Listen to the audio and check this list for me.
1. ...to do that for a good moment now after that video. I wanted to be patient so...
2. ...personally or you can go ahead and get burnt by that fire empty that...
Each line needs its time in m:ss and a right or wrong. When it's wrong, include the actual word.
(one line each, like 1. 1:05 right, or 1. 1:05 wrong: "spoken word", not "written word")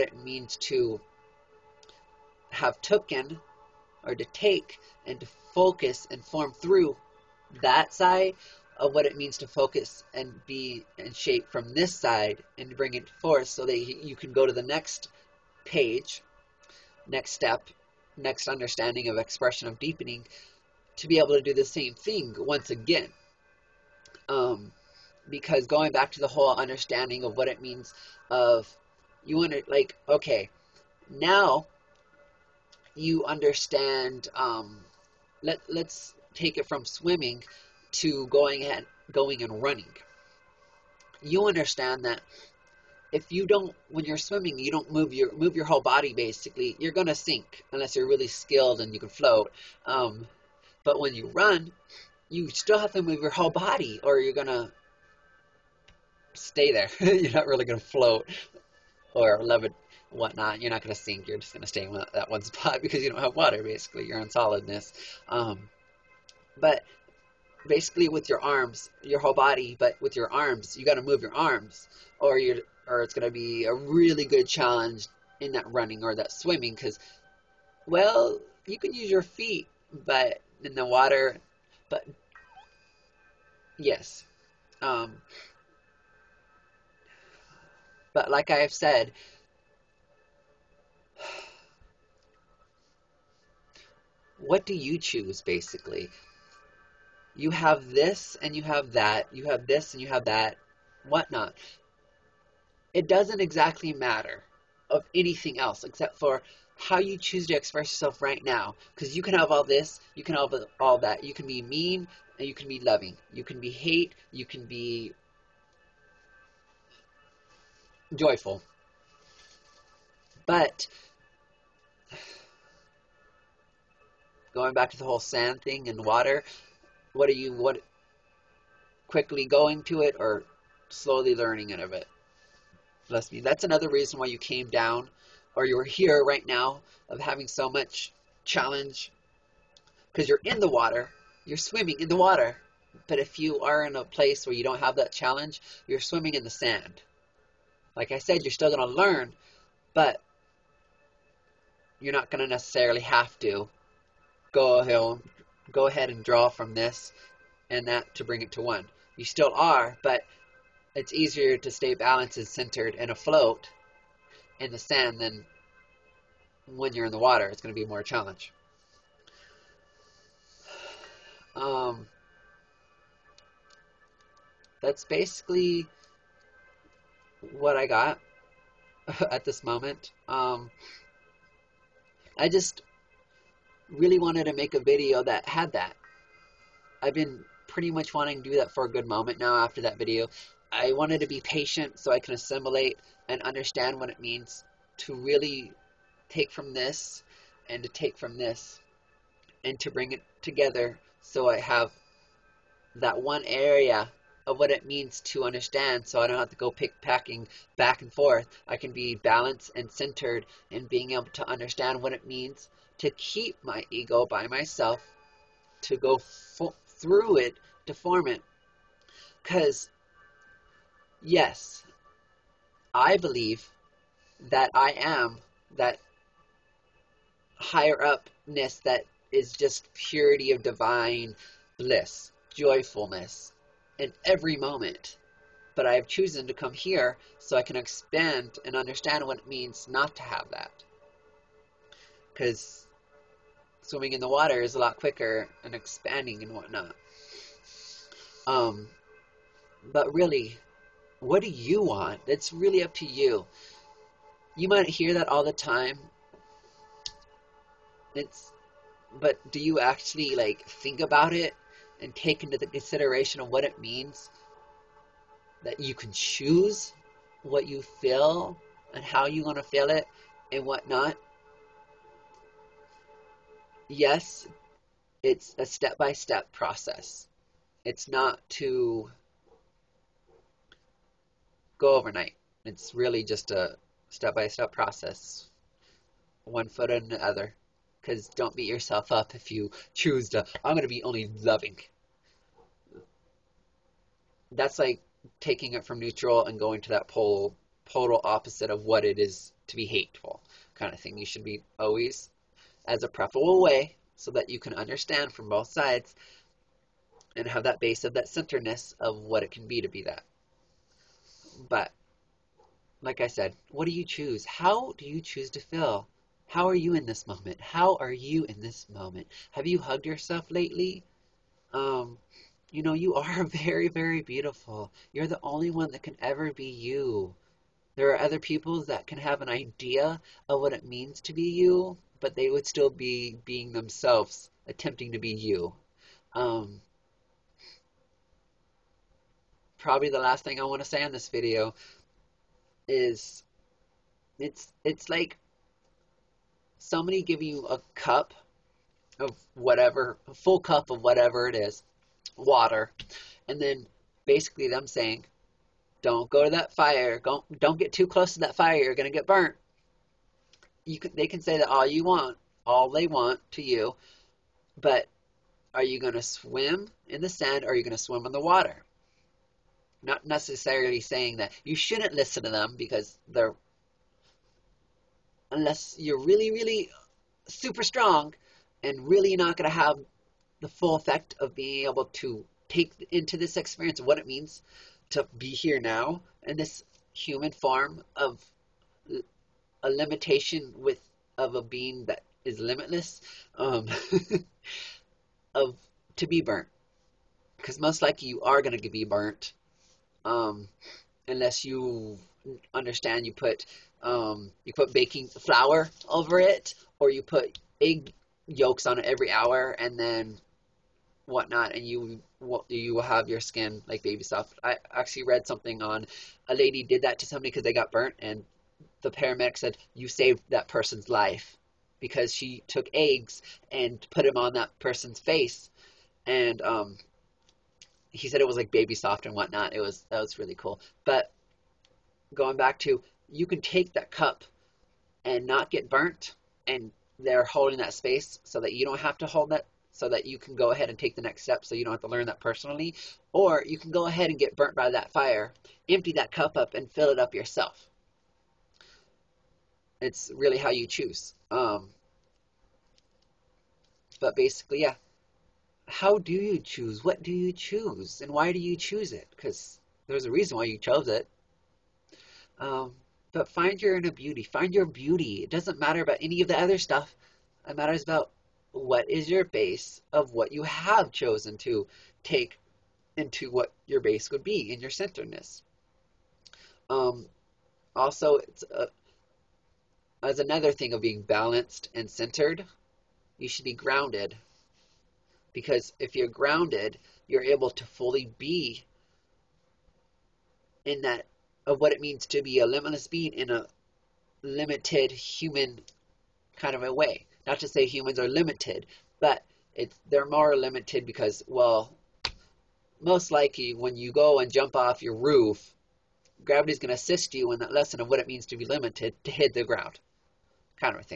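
1. 3:08 right
2. 7:22 right.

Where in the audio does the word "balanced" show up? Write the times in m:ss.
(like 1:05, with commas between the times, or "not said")
2:41, 3:29, 8:01.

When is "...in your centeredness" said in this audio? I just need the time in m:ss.
7:54.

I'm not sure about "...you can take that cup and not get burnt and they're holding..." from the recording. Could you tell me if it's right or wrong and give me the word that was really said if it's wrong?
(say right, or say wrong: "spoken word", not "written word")
right.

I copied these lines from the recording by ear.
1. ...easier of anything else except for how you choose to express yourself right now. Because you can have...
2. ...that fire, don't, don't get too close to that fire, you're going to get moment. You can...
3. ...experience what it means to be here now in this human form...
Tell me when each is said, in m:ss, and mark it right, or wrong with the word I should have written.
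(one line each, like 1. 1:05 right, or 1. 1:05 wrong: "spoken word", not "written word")
1. 1:43 wrong: "matter", not "easier"
2. 5:56 wrong: "burnt", not "moment"
3. 6:23 right.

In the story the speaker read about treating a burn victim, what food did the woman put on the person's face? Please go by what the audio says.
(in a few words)
eggs.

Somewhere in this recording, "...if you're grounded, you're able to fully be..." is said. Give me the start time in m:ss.
8:05.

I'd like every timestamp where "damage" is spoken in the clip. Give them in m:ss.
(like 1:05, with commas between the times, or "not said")
not said.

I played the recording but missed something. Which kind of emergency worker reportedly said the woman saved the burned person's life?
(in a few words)
paramedic.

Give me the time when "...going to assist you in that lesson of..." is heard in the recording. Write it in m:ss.
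8:26.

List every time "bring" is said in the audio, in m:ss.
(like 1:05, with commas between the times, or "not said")
0:12, 2:38, 3:19.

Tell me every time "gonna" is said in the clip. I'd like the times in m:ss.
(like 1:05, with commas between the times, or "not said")
0:46, 0:54.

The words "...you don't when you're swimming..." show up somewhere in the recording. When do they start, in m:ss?
0:43.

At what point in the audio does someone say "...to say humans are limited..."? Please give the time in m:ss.
8:17.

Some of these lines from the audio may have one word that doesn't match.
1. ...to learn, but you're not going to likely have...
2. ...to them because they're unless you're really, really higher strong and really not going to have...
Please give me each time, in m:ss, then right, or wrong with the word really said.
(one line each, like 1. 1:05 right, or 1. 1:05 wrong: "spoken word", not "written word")
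1. 2:28 wrong: "necessarily", not "likely"
2. 6:12 wrong: "super", not "higher".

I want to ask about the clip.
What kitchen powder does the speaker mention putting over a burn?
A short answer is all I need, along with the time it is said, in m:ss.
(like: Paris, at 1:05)
baking flour, at 6:44.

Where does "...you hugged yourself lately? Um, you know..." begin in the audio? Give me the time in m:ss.
5:19.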